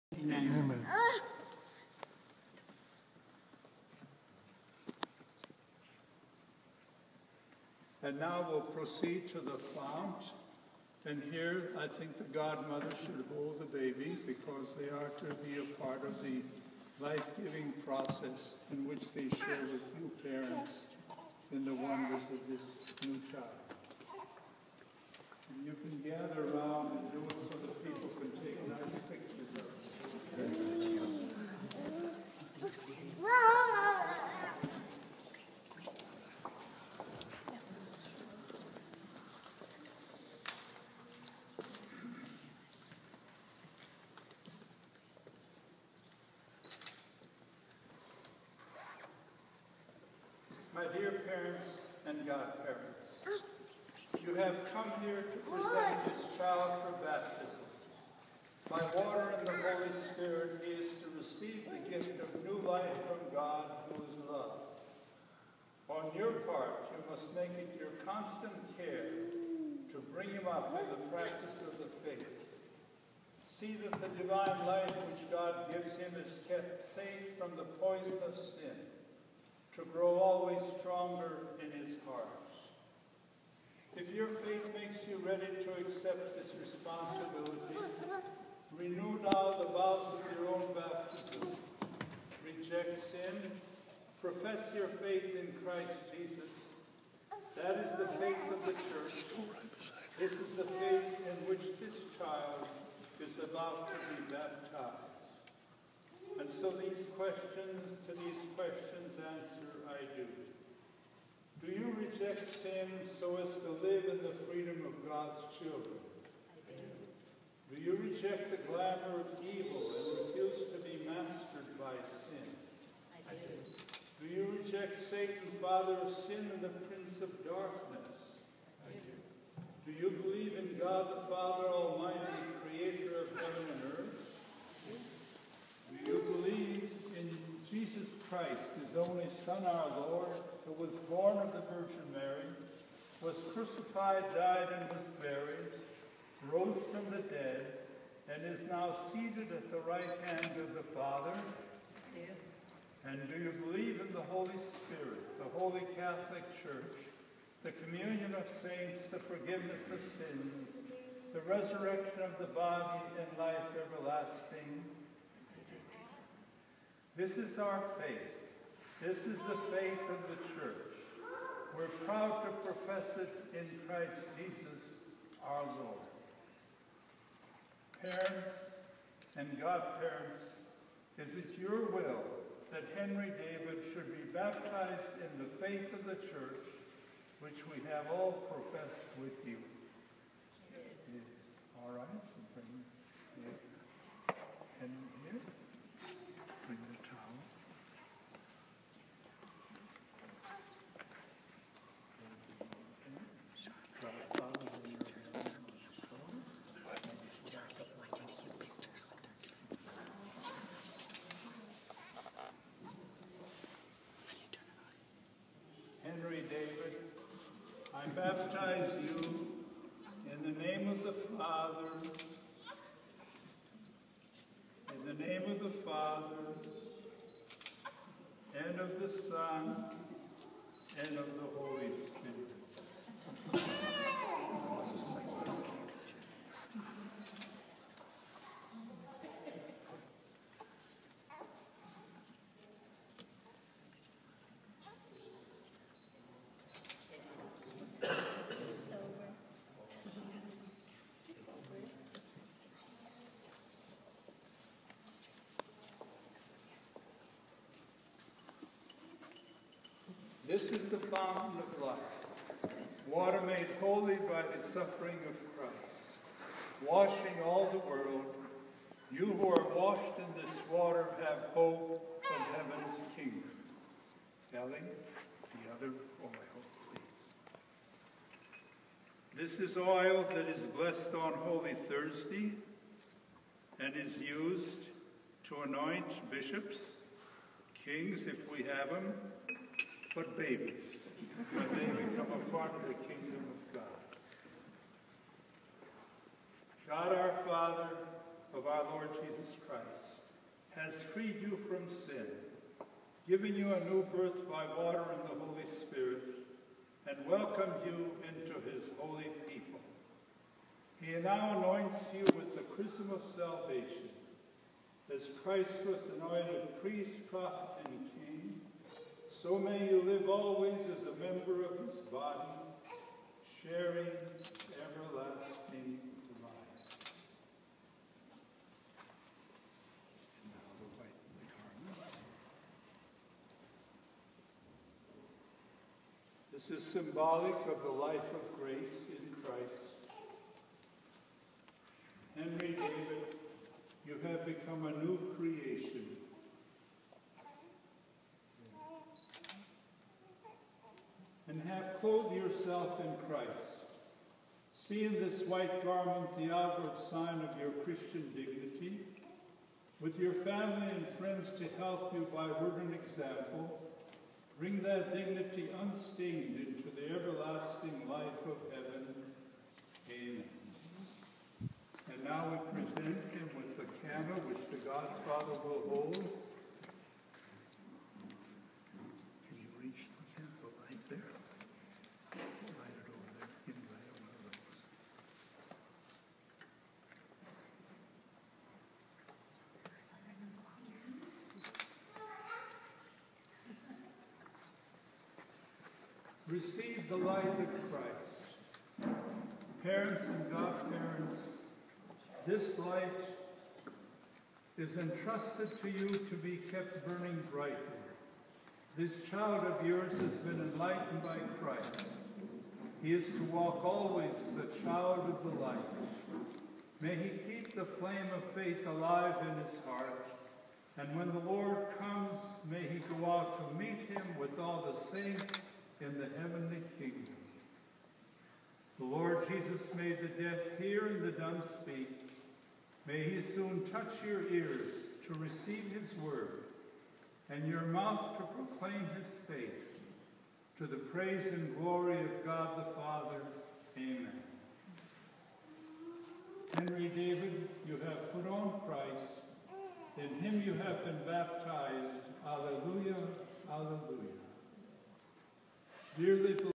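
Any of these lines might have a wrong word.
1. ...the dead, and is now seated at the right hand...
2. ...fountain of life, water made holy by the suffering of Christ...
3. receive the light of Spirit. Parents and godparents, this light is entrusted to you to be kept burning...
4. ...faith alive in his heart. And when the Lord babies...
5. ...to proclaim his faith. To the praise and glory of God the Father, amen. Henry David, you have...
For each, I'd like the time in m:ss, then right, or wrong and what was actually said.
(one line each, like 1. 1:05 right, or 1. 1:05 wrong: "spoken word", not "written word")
1. 2:27 right
2. 4:20 right
3. 6:36 wrong: "Christ", not "Spirit"
4. 6:58 wrong: "comes", not "babies"
5. 7:18 right.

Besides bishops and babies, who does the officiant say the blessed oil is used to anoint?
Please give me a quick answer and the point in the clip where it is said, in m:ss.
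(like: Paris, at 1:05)
Kings, at 4:47.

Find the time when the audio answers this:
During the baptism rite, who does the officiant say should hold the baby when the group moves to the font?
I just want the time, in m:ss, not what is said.
0:12.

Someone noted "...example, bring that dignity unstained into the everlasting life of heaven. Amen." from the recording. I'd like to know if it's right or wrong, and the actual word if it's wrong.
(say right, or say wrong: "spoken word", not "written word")
right.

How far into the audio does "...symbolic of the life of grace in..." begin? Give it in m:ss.
5:36.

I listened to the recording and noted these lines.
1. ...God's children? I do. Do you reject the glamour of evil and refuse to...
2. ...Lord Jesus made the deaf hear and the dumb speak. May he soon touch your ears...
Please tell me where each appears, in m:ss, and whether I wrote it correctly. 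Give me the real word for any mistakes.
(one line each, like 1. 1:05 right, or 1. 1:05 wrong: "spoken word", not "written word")
1. 1:55 right
2. 7:09 right.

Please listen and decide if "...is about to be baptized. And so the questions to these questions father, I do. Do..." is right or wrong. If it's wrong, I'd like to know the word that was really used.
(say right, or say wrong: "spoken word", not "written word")
wrong: "answer", not "father".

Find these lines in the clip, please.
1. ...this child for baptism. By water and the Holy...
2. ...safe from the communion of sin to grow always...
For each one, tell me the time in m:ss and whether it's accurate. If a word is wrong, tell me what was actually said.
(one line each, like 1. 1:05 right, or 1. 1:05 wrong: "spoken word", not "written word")
1. 0:56 right
2. 1:16 wrong: "poison", not "communion".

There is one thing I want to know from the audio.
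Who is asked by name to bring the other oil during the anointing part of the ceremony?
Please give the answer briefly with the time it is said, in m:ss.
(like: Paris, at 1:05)
Ellie, at 4:34.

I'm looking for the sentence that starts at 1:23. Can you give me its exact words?
If your faith makes you ready to accept this responsibility, renew now the vows of your own baptism.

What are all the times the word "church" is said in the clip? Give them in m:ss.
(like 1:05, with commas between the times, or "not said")
1:38, 2:36, 2:50, 3:06.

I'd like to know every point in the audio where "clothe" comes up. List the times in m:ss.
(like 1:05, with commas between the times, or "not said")
5:52.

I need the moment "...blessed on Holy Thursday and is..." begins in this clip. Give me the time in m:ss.
4:40.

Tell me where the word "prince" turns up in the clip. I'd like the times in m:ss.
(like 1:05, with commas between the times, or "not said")
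2:06.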